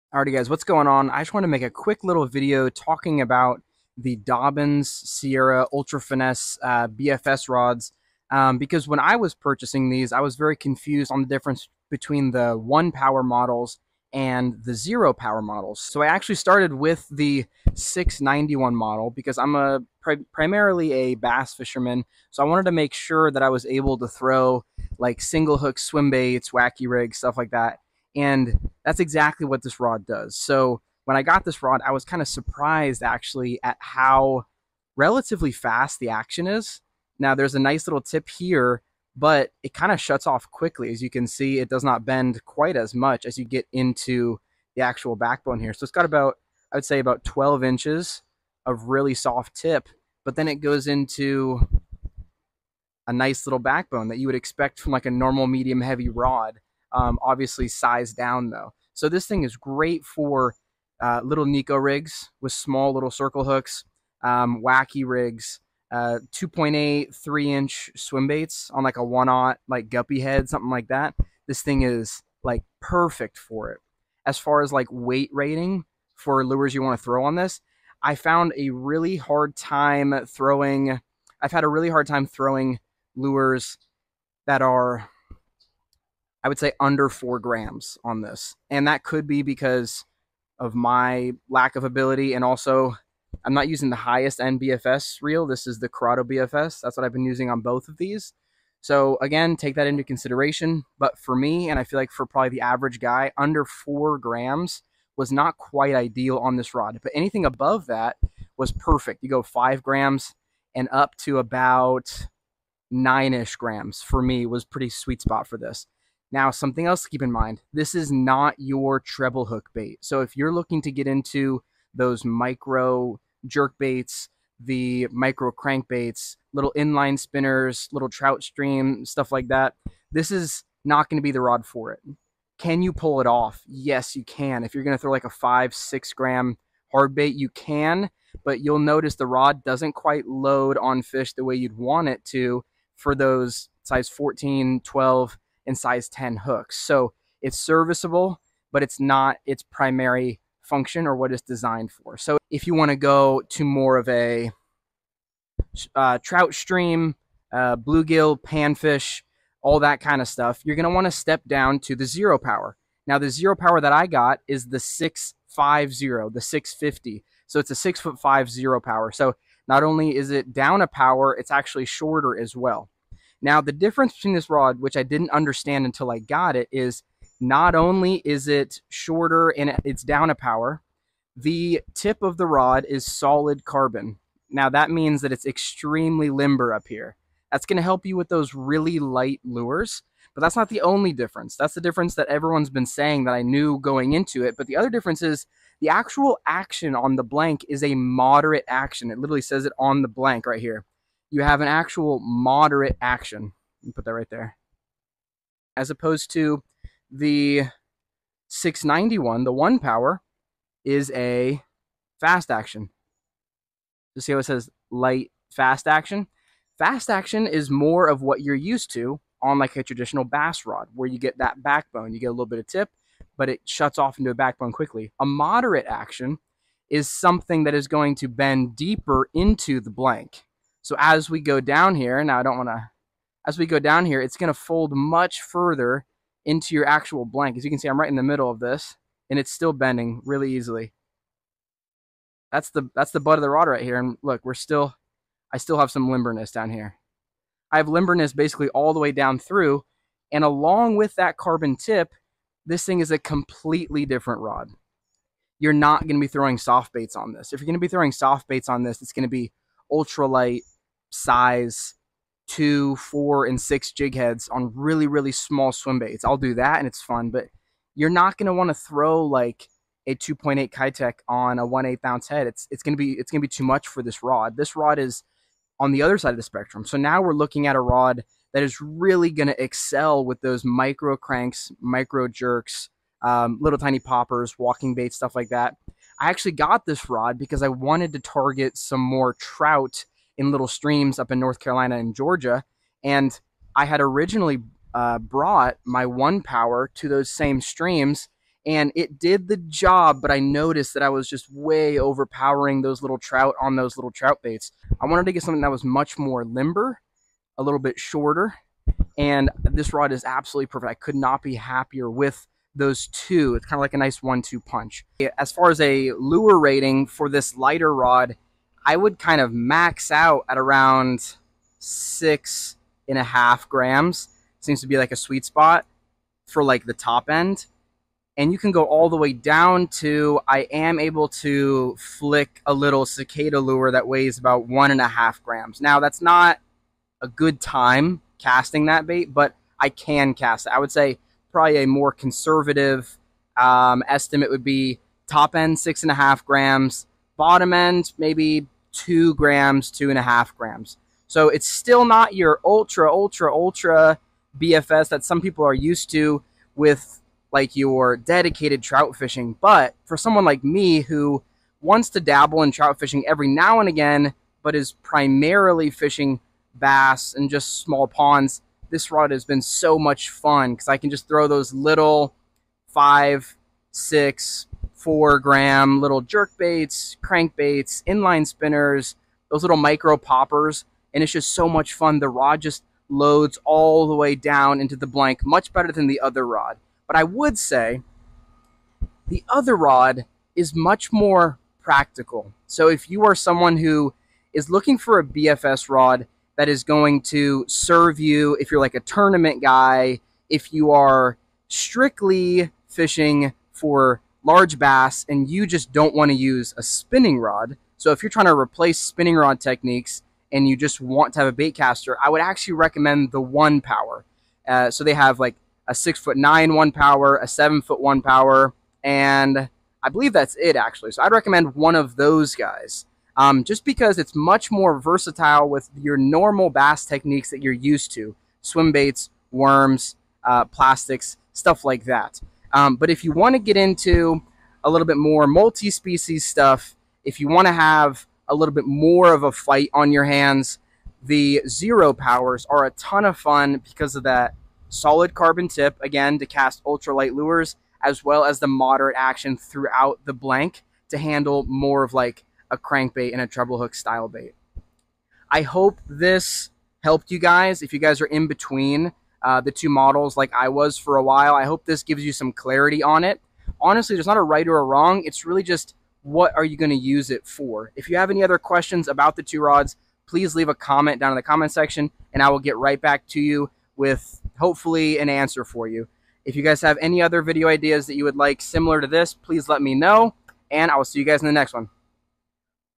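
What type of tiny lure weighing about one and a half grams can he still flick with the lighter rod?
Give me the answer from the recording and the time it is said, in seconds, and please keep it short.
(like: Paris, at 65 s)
cicada lure, at 333 s.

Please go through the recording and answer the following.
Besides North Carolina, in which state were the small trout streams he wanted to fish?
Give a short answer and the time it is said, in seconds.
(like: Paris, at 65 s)
Georgia, at 292 s.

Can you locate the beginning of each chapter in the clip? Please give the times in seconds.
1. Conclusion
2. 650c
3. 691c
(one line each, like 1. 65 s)
1. 371 s
2. 152 s
3. 16 s.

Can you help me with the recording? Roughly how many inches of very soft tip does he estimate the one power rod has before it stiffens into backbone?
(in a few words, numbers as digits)
12 inches.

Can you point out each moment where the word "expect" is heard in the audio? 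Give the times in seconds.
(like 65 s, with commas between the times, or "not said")
54 s.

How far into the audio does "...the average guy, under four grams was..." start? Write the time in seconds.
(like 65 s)
102 s.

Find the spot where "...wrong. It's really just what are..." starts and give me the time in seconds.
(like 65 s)
464 s.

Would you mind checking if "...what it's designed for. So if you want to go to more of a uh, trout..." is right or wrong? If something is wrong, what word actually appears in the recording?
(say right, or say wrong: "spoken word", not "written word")
right.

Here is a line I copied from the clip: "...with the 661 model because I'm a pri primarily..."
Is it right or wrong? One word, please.
wrong.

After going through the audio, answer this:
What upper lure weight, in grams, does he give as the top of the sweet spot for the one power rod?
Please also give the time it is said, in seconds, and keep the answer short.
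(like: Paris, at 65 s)
9 grams, at 112 s.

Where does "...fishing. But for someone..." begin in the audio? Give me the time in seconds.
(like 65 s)
359 s.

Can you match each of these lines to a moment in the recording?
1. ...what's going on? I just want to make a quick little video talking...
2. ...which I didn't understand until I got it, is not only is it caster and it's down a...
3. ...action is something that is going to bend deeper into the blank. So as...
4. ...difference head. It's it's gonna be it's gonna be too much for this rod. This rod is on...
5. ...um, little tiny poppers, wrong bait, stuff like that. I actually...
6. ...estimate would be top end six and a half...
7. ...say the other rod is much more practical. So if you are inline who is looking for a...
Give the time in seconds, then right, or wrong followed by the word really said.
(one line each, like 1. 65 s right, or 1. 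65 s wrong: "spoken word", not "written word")
1. 0 s right
2. 174 s wrong: "shorter", not "caster"
3. 225 s right
4. 272 s wrong: "ounce", not "difference"
5. 283 s wrong: "walking", not "wrong"
6. 344 s right
7. 387 s wrong: "someone", not "inline".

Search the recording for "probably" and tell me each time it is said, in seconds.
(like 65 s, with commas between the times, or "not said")
102 s, 341 s.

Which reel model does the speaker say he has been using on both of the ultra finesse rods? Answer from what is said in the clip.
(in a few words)
Curado BFS.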